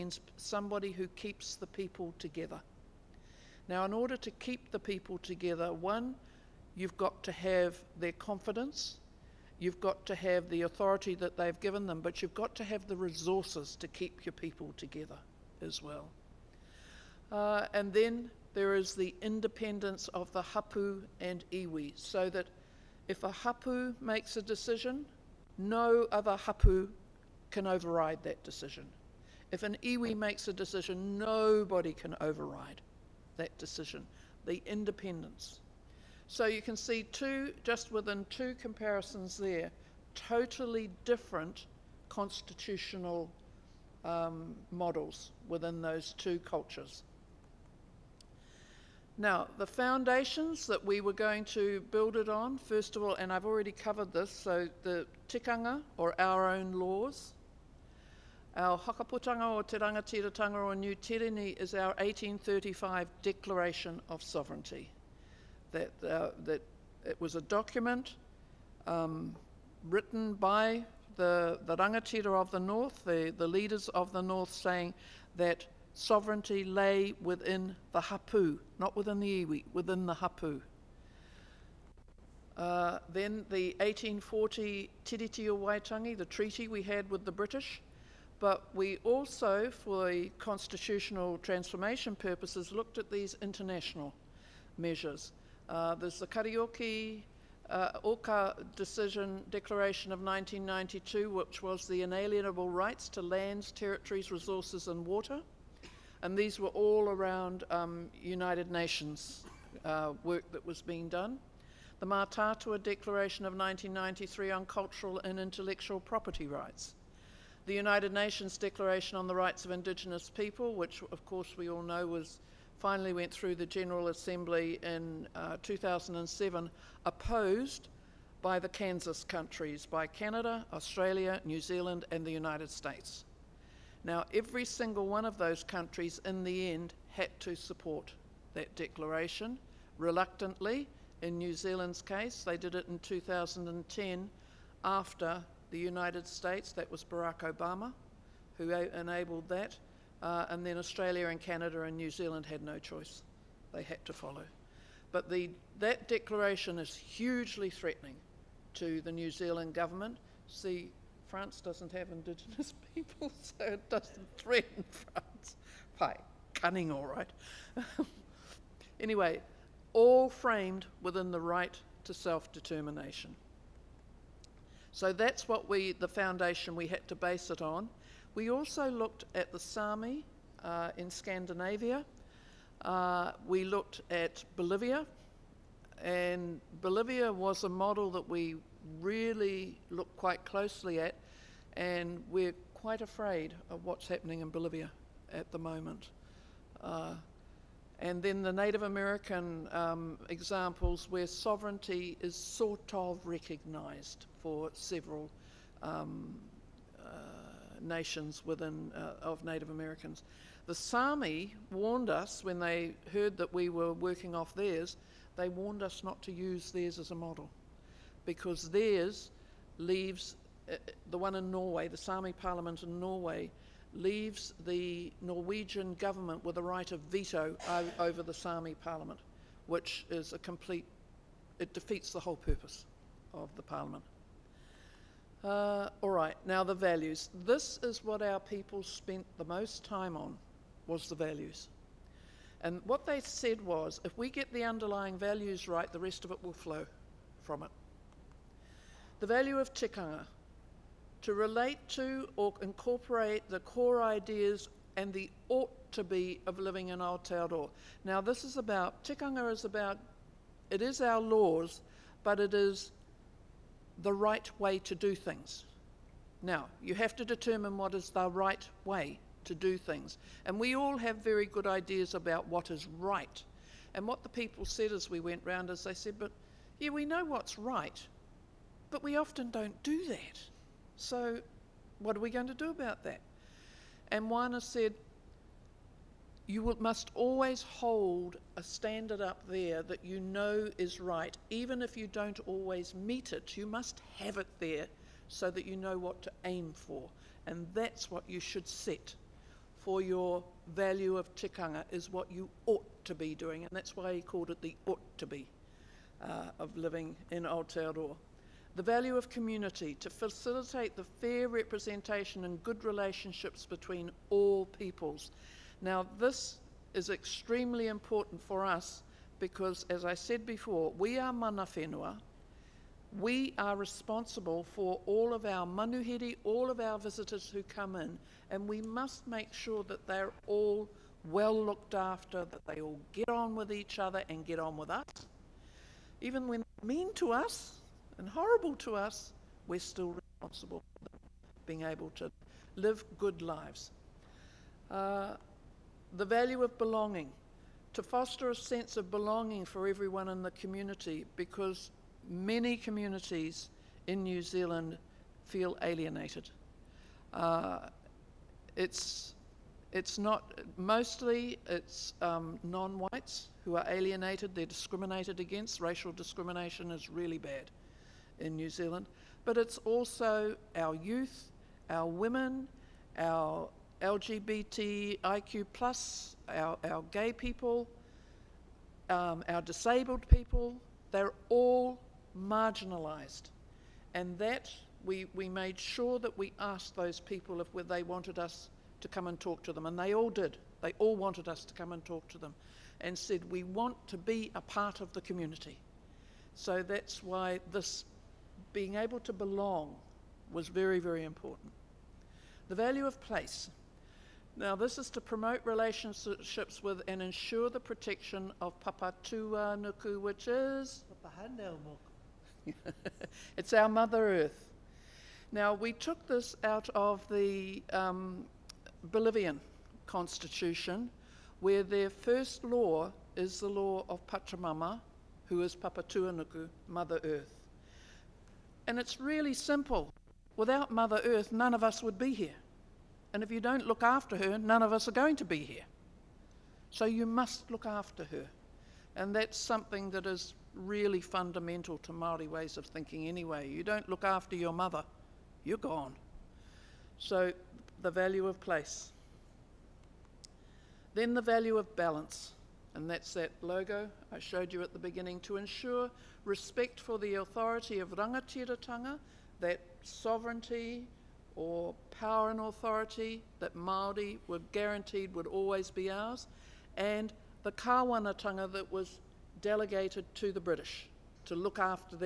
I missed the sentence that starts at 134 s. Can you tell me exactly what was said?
Now, every single one of those countries in the end had to support that declaration.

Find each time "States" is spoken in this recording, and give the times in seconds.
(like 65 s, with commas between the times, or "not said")
132 s, 146 s.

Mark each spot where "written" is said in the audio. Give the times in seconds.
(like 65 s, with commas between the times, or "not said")
69 s.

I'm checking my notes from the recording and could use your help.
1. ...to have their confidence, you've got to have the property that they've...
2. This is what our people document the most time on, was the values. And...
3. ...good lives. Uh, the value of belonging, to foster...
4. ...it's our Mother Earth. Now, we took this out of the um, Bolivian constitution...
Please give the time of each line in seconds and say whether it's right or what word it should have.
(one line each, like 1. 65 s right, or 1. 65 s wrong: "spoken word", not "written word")
1. 7 s wrong: "authority", not "property"
2. 237 s wrong: "spent", not "document"
3. 343 s right
4. 413 s right.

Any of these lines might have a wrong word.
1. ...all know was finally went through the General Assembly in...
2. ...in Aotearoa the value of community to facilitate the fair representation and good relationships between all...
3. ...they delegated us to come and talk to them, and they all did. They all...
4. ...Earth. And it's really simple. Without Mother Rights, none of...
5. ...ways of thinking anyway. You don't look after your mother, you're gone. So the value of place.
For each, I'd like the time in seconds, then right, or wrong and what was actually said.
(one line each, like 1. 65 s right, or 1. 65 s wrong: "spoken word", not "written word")
1. 121 s right
2. 307 s right
3. 387 s wrong: "wanted", not "delegated"
4. 427 s wrong: "Earth", not "Rights"
5. 442 s right.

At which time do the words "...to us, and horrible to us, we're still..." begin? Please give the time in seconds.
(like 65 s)
337 s.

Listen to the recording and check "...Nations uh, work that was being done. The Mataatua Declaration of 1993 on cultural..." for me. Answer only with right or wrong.
right.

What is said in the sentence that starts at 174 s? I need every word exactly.
So that's what we, the foundation we had to base it on.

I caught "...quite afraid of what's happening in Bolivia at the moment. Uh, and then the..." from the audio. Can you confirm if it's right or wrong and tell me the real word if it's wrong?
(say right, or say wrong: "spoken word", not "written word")
right.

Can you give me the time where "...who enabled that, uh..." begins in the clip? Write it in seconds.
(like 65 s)
148 s.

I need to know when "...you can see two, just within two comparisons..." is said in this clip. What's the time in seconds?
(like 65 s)
36 s.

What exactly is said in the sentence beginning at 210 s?
The Sami warned us when they heard that we were working off theirs.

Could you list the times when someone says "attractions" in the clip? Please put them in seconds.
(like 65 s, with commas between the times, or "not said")
not said.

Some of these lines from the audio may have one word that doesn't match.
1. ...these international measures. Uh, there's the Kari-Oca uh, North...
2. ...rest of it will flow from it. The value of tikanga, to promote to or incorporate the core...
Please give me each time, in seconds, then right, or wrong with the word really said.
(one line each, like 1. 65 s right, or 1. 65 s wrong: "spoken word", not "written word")
1. 93 s wrong: "Oka", not "North"
2. 245 s wrong: "relate", not "promote".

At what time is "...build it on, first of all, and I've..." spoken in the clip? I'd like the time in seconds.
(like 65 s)
51 s.